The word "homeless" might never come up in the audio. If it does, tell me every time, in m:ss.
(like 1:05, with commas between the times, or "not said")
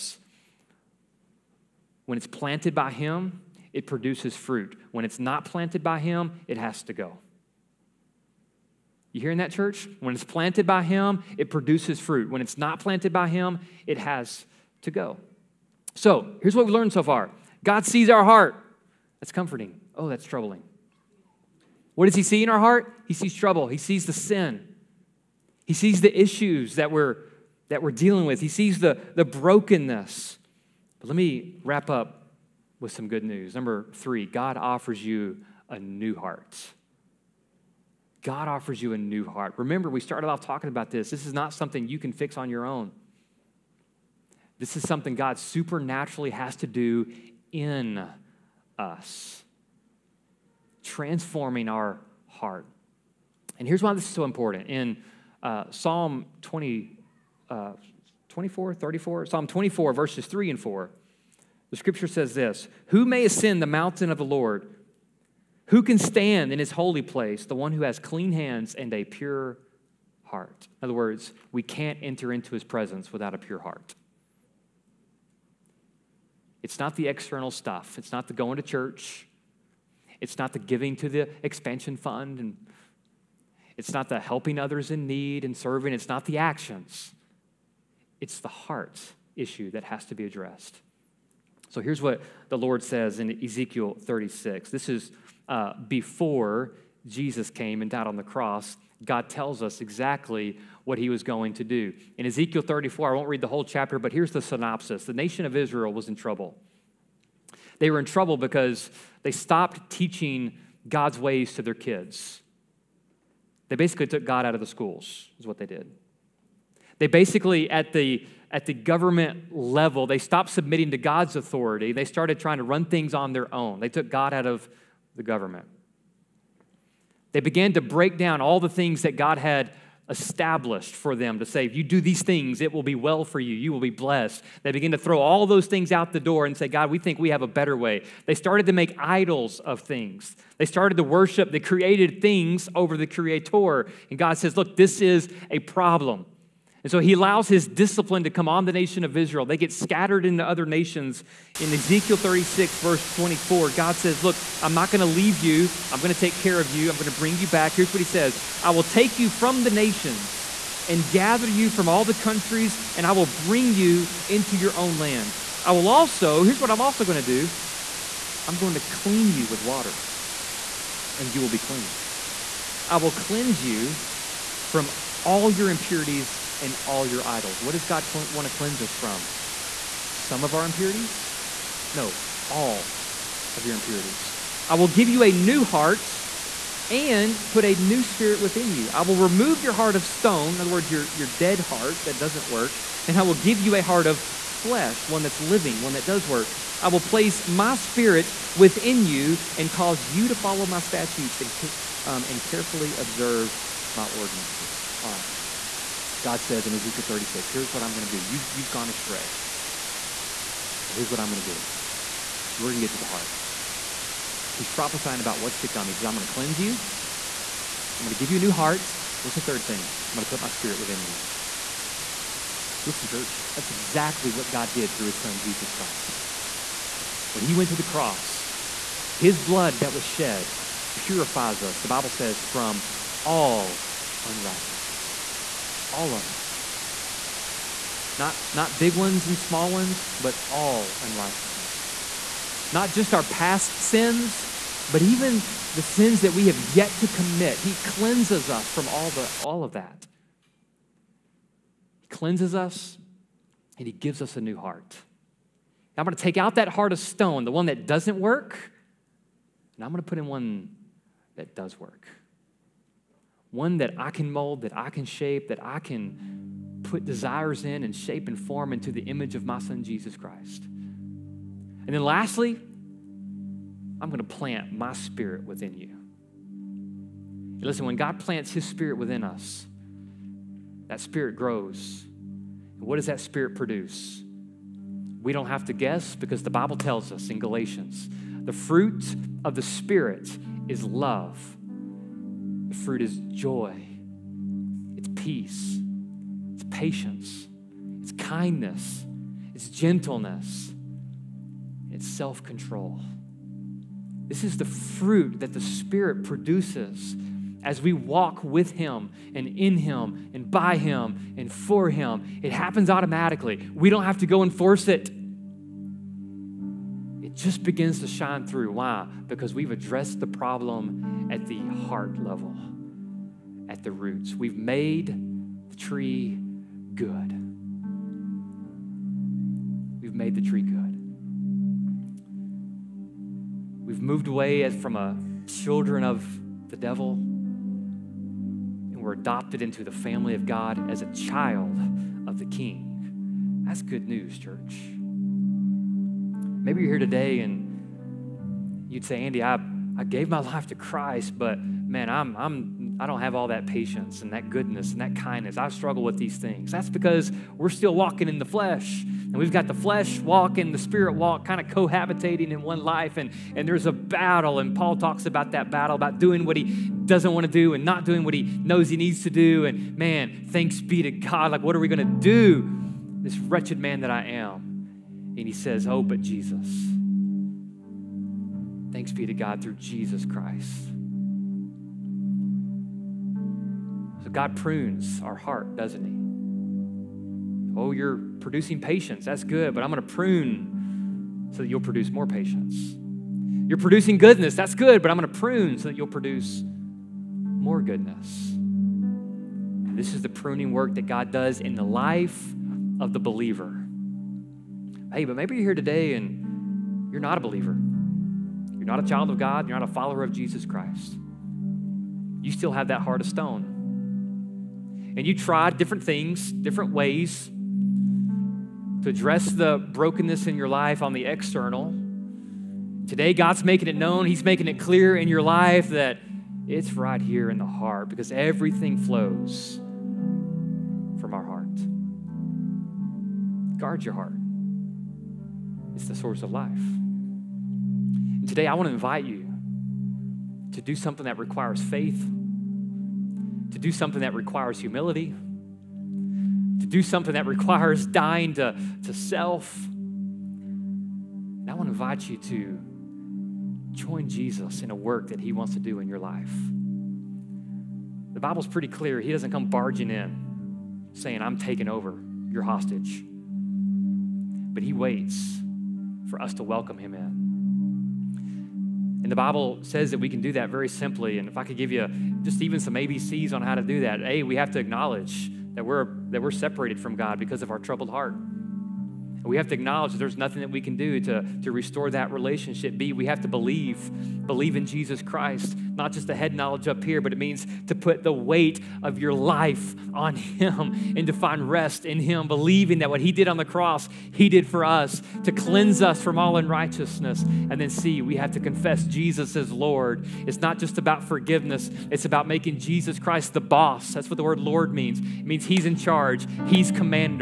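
not said.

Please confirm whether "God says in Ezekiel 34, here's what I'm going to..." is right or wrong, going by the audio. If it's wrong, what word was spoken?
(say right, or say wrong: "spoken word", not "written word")
wrong: "36", not "34".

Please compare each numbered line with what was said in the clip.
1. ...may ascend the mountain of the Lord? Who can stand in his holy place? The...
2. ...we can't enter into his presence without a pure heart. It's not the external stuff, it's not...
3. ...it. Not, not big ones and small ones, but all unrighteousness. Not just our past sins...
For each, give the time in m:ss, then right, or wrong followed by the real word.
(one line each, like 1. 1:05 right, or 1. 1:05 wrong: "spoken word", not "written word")
1. 1:03 right
2. 1:11 right
3. 3:56 right.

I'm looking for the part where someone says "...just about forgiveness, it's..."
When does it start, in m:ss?
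8:20.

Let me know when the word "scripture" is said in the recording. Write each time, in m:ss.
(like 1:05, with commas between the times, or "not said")
1:01.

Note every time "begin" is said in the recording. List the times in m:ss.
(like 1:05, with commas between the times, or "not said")
2:14, 5:17.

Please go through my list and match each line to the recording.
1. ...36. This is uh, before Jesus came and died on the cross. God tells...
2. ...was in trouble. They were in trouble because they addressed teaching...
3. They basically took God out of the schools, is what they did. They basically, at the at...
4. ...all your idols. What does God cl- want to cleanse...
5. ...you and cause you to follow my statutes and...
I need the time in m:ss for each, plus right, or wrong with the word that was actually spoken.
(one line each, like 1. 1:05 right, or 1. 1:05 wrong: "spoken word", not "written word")
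1. 1:33 right
2. 1:45 wrong: "stopped", not "addressed"
3. 1:53 right
4. 2:56 right
5. 3:19 right.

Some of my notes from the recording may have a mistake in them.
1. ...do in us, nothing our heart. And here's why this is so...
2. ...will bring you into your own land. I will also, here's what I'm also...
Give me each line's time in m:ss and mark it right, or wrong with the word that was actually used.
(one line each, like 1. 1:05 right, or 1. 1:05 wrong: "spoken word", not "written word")
1. 0:46 wrong: "transforming", not "nothing"
2. 2:43 right.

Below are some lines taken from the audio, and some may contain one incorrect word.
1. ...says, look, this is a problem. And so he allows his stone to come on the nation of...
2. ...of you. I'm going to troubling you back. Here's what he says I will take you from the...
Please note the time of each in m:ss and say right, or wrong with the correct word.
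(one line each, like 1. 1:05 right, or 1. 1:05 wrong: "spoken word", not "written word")
1. 2:24 wrong: "discipline", not "stone"
2. 2:36 wrong: "bring", not "troubling".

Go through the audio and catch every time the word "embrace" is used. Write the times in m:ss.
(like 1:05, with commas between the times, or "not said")
not said.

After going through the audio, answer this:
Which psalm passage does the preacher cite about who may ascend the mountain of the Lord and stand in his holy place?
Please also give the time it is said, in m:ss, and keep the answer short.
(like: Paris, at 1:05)
Psalm 24, verses 3 and 4, at 0:59.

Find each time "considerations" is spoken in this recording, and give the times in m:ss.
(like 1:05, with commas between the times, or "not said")
not said.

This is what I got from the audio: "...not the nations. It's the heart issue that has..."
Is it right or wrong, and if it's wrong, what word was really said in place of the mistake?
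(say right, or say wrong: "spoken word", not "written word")
wrong: "actions", not "nations".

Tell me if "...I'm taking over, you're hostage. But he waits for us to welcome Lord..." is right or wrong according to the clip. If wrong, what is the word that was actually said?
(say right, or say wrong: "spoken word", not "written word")
wrong: "Him", not "Lord".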